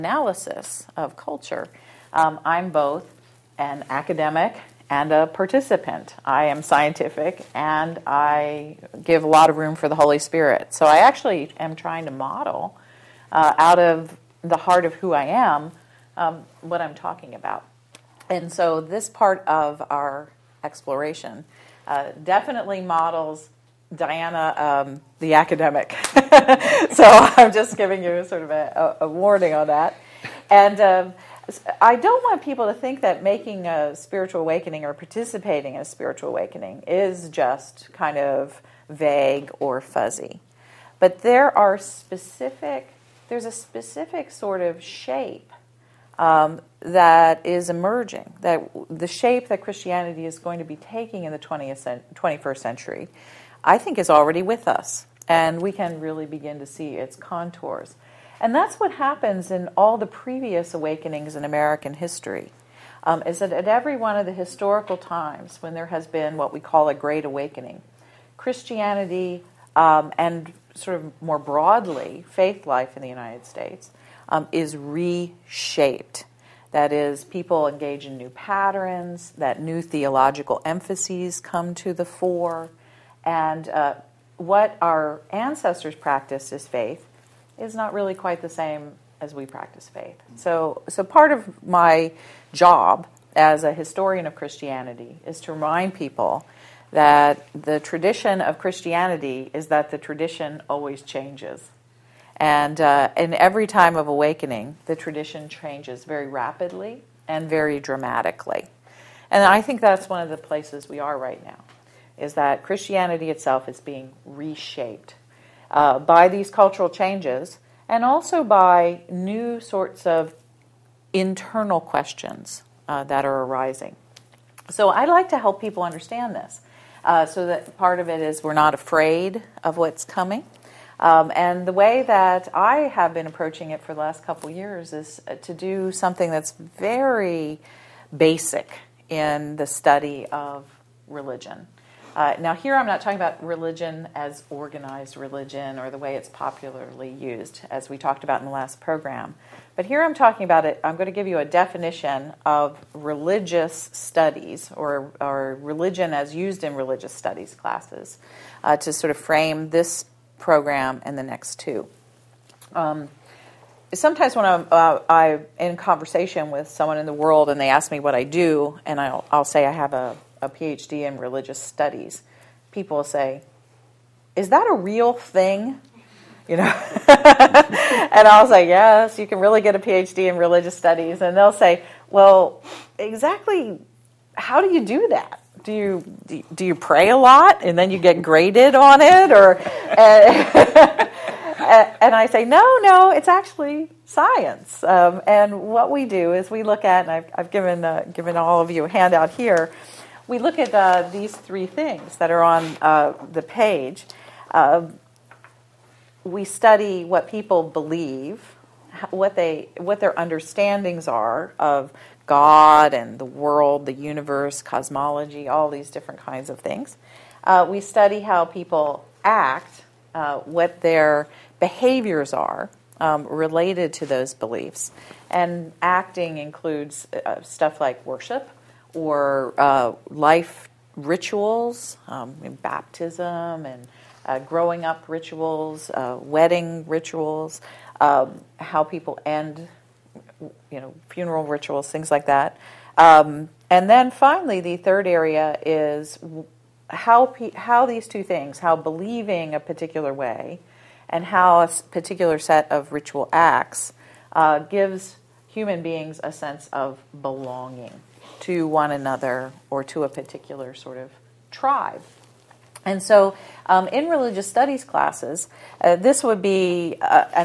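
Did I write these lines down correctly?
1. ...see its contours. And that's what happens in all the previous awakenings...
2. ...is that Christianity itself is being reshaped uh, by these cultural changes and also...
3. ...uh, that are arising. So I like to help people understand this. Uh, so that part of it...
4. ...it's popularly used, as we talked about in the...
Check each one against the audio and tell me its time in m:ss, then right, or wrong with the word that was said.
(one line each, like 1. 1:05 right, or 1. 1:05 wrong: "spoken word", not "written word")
1. 0:56 right
2. 1:52 right
3. 2:02 right
4. 2:26 right.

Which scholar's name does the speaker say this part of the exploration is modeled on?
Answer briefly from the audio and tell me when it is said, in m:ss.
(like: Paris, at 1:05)
Diana, at 0:23.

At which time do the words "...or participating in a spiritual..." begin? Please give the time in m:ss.
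0:34.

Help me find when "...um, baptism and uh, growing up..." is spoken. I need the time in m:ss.
3:52.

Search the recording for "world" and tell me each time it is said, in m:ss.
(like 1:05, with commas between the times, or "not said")
2:47, 3:33.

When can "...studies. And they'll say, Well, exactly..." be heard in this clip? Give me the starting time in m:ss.
3:00.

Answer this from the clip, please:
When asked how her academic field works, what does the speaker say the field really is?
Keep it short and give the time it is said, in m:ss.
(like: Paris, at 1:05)
science, at 3:13.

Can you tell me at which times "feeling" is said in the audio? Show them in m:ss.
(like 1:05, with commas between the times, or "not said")
not said.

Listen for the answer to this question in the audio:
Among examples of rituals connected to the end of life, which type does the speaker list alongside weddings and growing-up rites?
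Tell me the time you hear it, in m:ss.
4:01.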